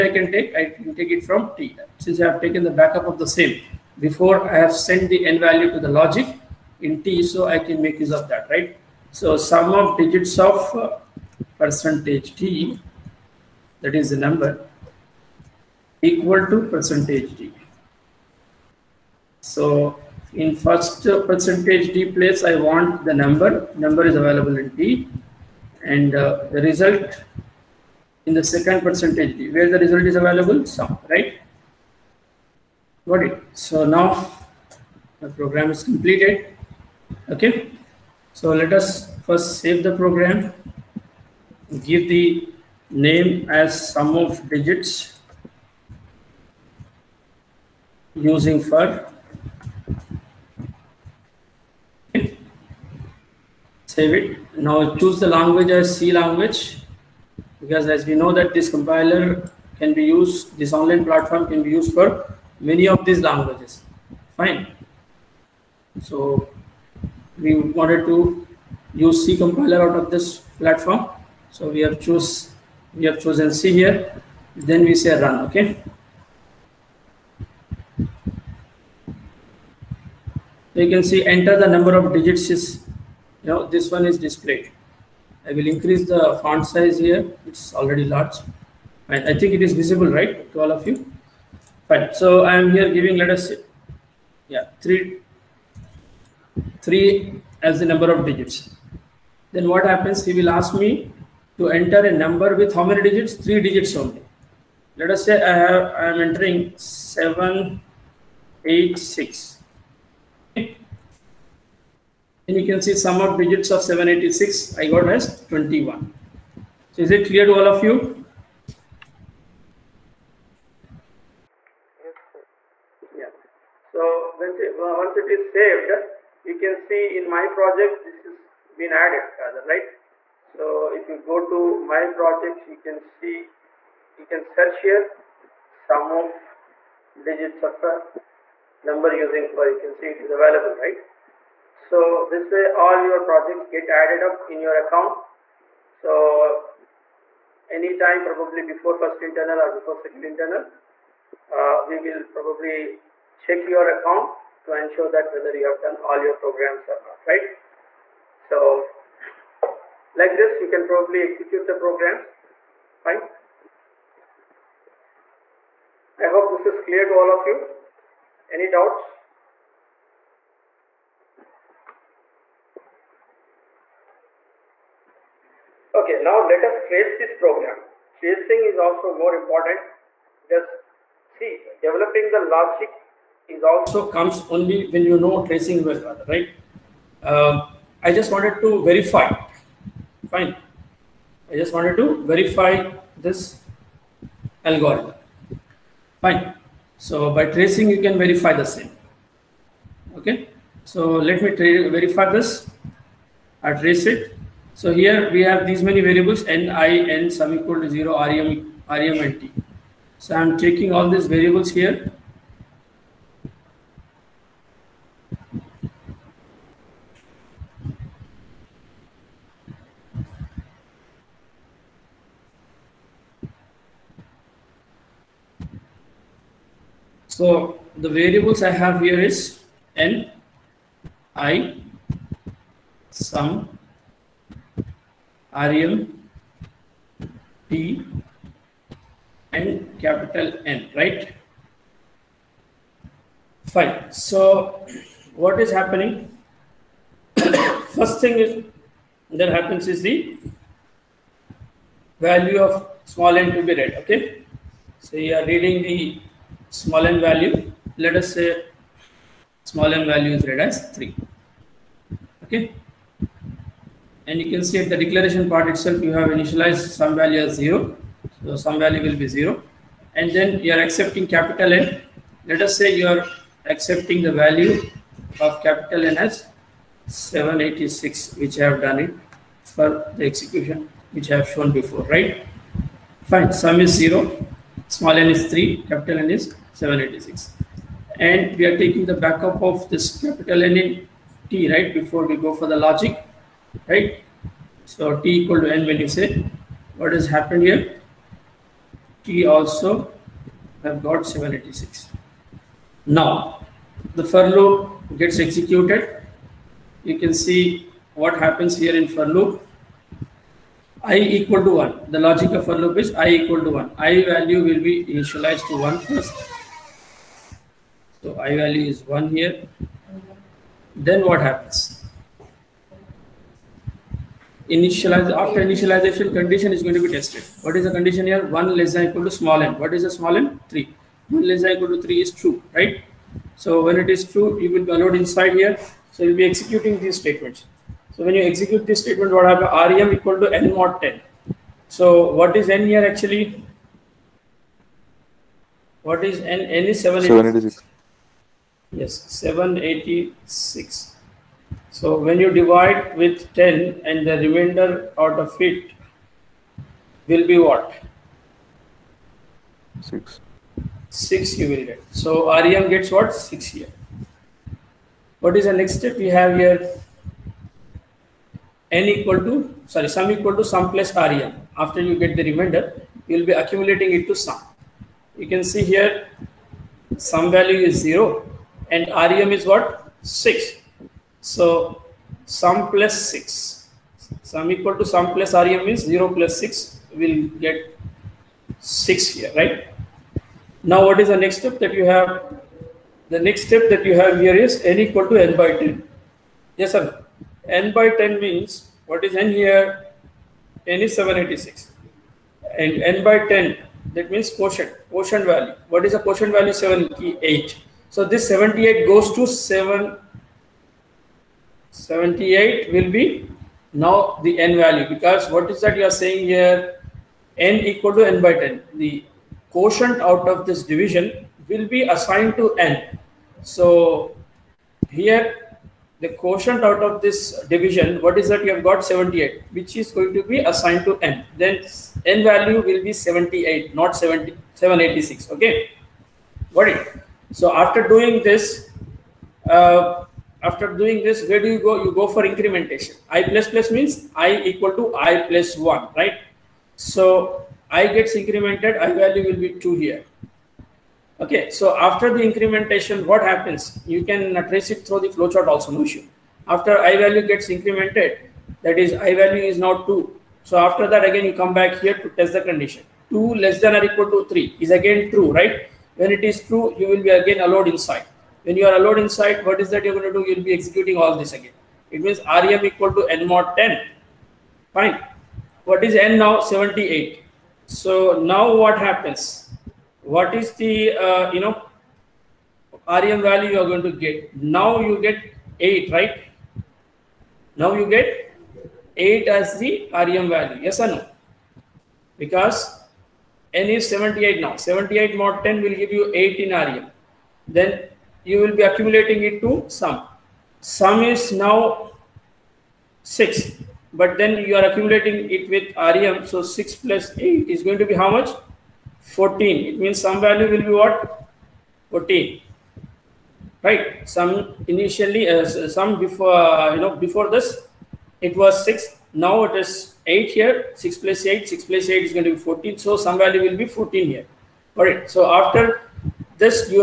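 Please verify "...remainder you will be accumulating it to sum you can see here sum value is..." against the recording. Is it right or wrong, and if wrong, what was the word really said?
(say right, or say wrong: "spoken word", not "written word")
right.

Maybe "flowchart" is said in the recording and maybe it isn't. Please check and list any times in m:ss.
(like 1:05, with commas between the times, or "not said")
7:35.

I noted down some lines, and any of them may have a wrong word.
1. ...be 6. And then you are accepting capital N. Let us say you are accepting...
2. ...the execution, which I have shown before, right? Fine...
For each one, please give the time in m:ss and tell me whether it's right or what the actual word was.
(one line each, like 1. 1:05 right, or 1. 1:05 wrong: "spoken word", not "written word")
1. 4:29 wrong: "0", not "6"
2. 4:40 right.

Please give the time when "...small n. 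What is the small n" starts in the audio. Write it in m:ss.
5:29.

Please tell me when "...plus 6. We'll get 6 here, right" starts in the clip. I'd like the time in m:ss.
6:26.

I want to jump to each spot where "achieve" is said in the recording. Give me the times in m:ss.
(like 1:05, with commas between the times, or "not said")
not said.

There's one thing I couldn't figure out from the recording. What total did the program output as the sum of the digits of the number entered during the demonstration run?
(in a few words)
21.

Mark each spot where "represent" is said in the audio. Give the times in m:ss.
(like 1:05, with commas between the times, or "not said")
not said.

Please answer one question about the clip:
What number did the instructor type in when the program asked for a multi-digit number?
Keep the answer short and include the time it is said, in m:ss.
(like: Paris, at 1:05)
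786, at 1:46.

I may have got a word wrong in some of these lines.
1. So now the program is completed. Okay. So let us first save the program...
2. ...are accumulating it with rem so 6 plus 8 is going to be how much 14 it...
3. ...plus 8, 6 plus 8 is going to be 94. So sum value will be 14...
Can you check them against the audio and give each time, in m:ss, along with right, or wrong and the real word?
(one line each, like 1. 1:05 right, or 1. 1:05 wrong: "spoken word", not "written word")
1. 0:33 right
2. 8:24 right
3. 8:41 wrong: "14", not "94".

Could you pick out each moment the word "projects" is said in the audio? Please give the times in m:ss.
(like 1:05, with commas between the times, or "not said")
2:07, 2:12, 2:23.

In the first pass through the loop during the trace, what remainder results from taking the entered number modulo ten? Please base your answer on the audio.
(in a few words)
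6.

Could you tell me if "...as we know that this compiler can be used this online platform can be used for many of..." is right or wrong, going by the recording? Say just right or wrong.
right.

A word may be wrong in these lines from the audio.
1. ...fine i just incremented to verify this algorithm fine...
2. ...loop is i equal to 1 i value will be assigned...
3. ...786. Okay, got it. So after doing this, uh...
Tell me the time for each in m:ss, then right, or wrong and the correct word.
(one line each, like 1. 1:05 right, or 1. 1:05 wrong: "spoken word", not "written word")
1. 3:10 wrong: "wanted", not "incremented"
2. 5:12 wrong: "initialized", not "assigned"
3. 7:14 right.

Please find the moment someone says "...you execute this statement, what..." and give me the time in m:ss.
5:38.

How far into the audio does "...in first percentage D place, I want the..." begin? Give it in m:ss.
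0:20.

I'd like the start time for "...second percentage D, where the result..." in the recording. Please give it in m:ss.
0:28.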